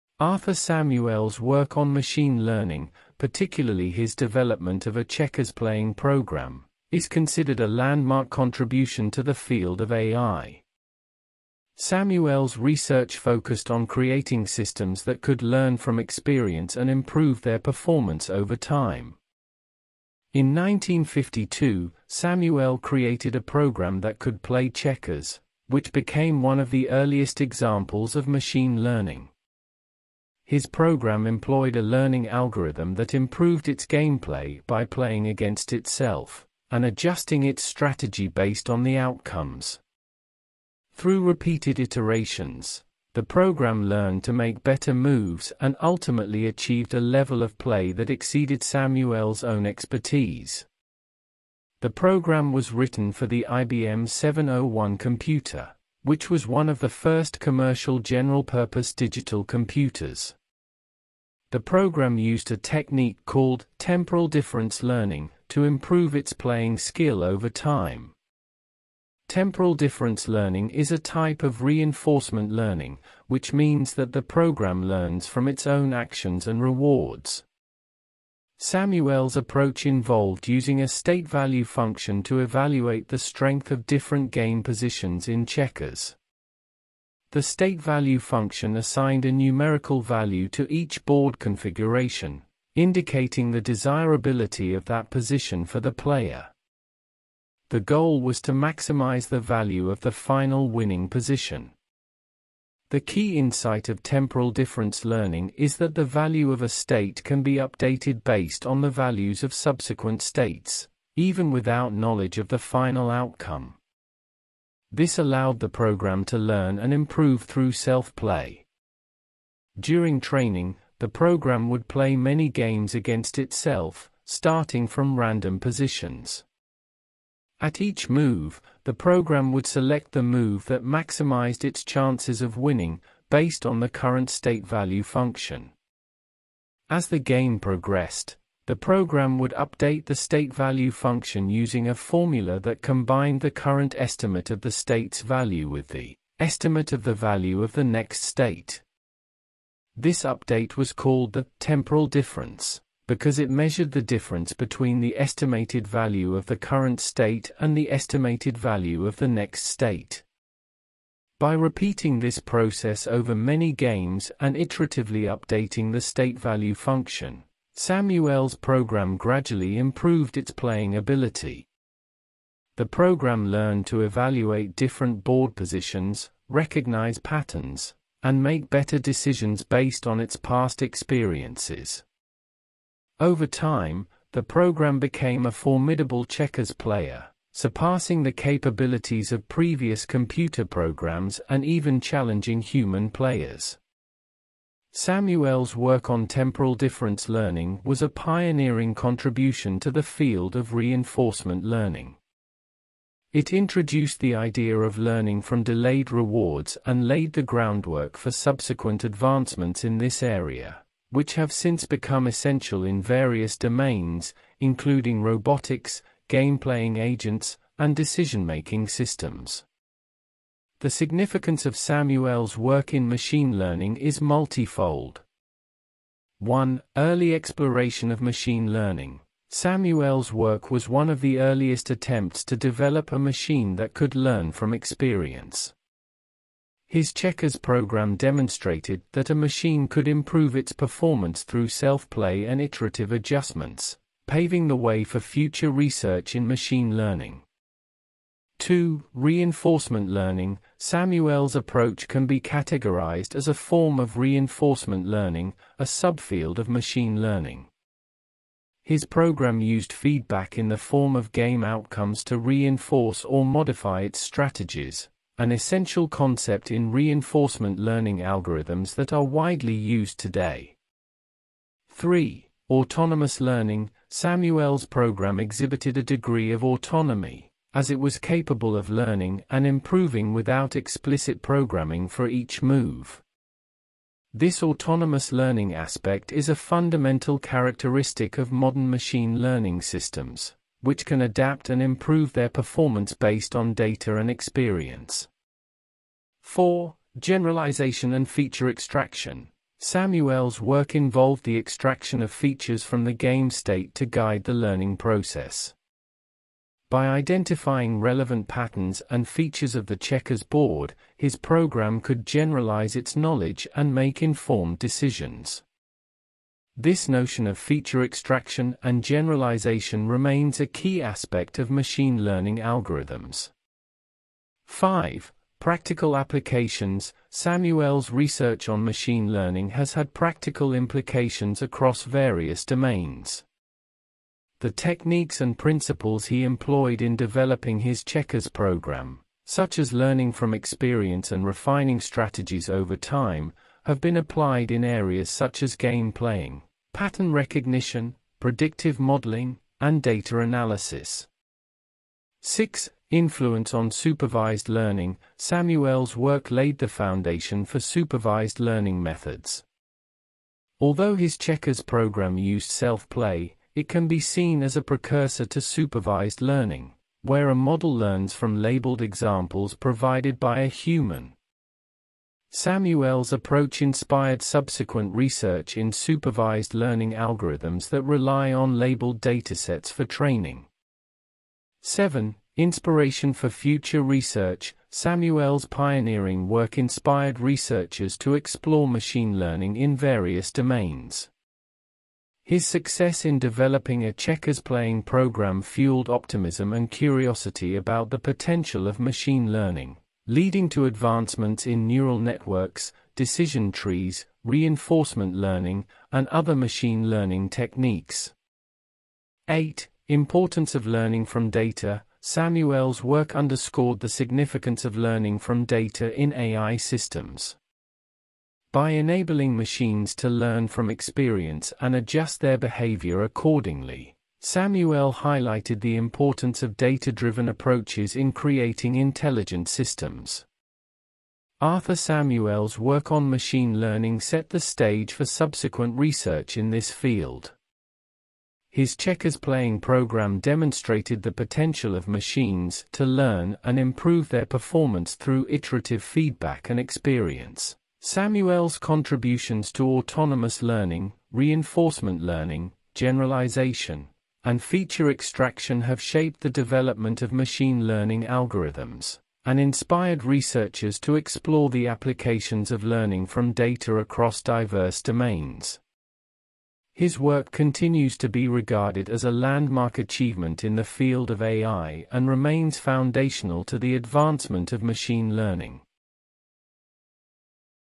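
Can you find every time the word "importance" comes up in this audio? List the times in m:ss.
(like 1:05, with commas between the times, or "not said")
6:50, 7:05.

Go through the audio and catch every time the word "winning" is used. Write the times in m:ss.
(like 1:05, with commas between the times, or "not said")
1:40, 2:12.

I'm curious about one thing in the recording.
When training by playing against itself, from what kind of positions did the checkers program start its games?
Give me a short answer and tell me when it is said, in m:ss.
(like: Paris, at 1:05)
Random positions, at 2:05.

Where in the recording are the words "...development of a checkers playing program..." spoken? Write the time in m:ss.
0:04.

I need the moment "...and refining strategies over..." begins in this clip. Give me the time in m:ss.
5:41.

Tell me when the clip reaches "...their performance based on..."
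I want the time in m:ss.
4:52.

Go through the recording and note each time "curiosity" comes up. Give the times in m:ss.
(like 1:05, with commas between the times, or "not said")
6:36.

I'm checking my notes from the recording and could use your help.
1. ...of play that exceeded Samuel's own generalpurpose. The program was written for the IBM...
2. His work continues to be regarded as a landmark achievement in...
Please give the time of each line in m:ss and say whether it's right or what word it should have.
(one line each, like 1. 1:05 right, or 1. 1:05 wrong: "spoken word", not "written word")
1. 0:47 wrong: "expertise", not "generalpurpose"
2. 7:46 right.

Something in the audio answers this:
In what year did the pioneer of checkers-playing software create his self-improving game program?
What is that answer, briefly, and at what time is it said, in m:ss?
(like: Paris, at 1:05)
1952, at 0:20.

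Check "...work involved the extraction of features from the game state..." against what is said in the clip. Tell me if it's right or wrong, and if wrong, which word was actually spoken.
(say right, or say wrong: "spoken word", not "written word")
right.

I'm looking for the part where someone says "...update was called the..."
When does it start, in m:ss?
2:30.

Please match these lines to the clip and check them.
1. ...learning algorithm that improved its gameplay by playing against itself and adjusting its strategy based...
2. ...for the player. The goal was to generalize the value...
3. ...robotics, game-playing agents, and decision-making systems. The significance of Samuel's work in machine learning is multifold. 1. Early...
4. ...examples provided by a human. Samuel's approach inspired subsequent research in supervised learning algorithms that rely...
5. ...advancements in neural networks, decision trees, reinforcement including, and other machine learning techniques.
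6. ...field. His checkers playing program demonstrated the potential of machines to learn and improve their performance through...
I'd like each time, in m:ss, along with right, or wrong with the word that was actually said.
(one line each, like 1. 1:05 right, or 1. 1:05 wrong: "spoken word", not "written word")
1. 0:31 right
2. 1:35 wrong: "maximize", not "generalize"
3. 3:35 right
4. 6:09 right
5. 6:40 wrong: "learning", not "including"
6. 7:16 right.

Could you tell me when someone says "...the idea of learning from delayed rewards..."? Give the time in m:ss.
3:24.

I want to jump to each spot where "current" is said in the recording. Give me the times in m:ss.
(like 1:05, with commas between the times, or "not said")
2:13, 2:23, 2:36.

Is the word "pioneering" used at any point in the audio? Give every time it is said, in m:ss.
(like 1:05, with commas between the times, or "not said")
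3:18, 6:25.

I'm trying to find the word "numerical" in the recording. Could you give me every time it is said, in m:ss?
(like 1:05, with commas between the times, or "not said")
1:29.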